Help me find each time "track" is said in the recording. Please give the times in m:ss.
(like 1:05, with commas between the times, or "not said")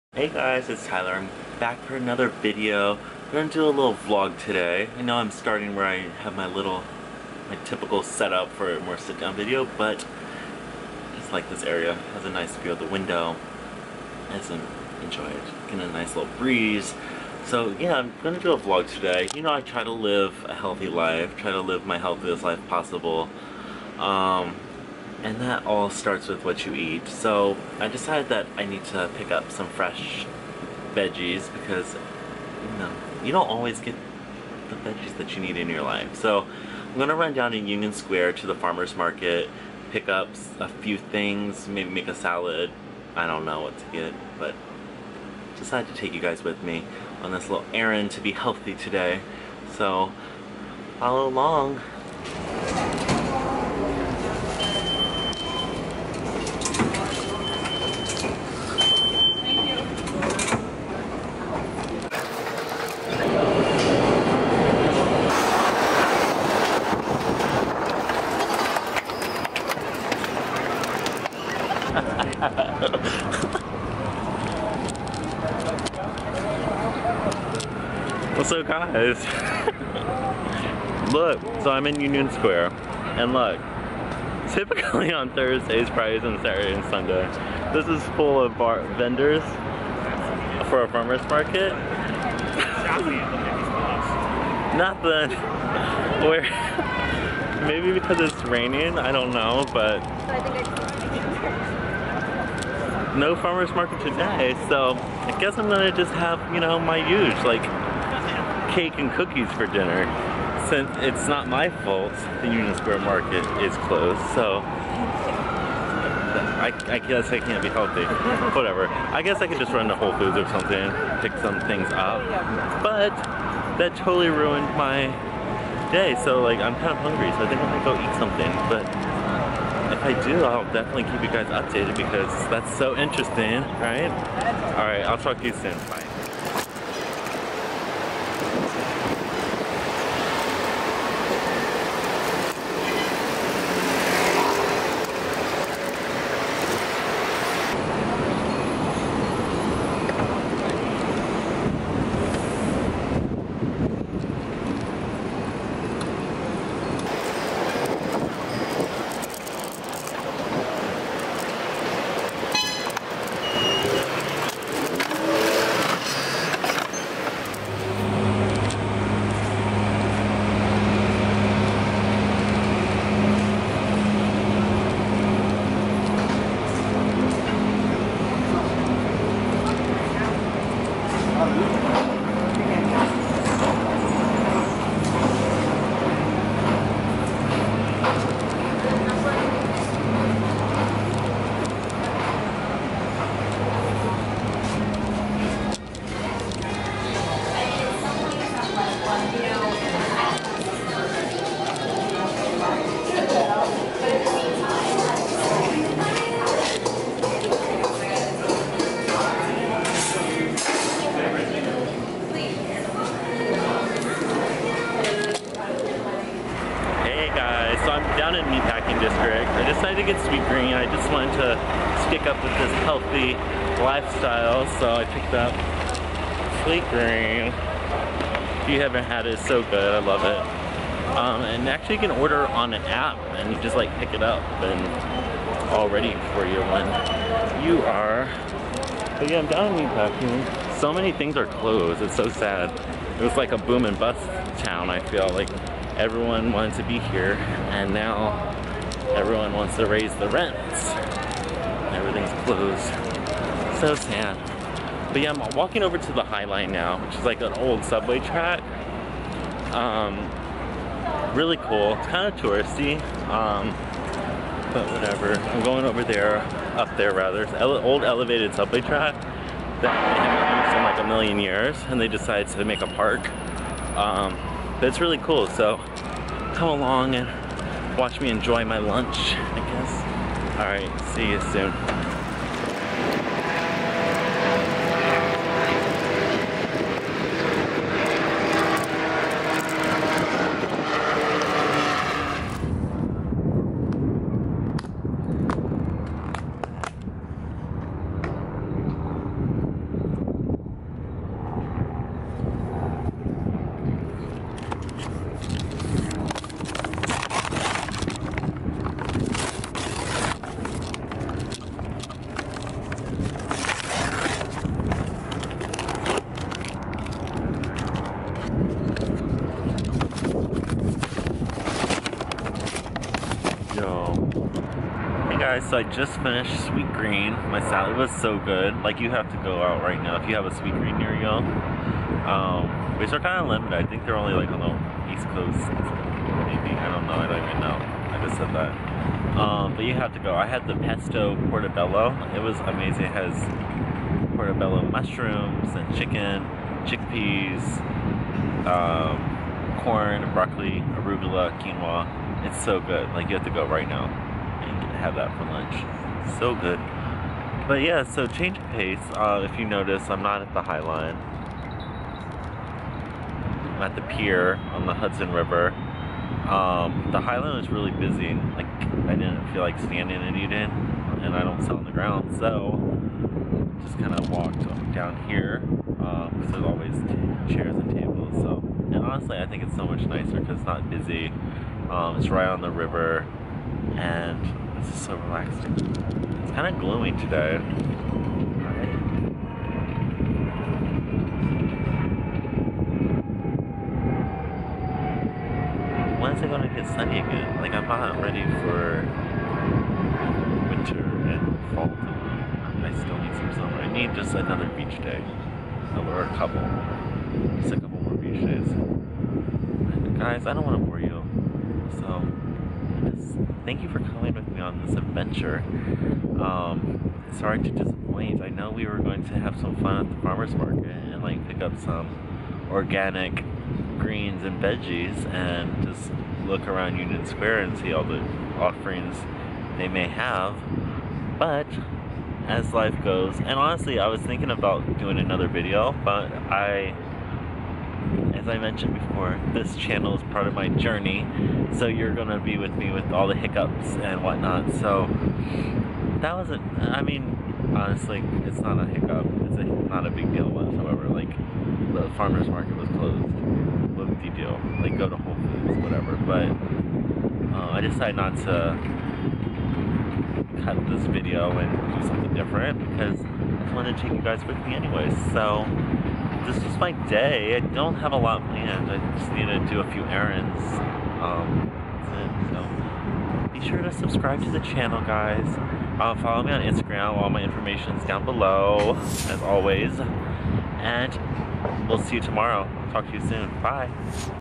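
4:18, 4:28.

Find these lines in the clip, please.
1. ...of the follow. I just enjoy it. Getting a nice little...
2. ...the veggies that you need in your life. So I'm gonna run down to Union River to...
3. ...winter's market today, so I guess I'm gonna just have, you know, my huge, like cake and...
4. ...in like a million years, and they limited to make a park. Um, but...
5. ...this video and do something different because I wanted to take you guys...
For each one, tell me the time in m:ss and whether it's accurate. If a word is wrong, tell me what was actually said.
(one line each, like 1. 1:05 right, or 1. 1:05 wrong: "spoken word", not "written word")
1. 0:12 wrong: "window", not "follow"
2. 0:34 wrong: "Square", not "River"
3. 1:43 wrong: "farmer", not "winter"
4. 4:30 wrong: "decided", not "limited"
5. 7:40 right.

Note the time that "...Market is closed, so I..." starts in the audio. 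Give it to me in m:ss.
1:52.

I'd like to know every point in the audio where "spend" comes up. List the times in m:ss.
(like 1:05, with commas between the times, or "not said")
not said.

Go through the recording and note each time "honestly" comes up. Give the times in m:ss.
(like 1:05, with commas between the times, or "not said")
6:19, 7:13, 7:27.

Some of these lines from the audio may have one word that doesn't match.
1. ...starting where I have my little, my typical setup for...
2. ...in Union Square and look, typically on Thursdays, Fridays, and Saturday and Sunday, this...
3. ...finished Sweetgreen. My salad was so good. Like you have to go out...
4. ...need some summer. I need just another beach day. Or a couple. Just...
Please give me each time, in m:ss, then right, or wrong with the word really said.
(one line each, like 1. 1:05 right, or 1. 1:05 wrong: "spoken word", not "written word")
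1. 0:05 right
2. 1:21 right
3. 5:26 right
4. 6:43 right.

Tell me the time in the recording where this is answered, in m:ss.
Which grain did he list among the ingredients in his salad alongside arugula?
5:51.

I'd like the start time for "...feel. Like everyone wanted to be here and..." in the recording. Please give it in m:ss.
4:04.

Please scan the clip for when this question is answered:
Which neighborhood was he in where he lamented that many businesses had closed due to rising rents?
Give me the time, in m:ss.
3:59.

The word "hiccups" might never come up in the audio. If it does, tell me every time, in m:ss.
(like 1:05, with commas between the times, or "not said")
7:23, 7:28.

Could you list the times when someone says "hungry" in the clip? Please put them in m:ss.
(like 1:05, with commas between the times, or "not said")
2:06.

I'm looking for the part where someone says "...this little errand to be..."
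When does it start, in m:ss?
0:47.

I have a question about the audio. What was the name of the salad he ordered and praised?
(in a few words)
Pesto portobello.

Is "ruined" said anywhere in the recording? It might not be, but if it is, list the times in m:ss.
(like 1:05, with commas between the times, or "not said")
2:04.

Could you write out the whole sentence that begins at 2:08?
But if I do, I'll definitely keep you guys updated because that's so interesting, right?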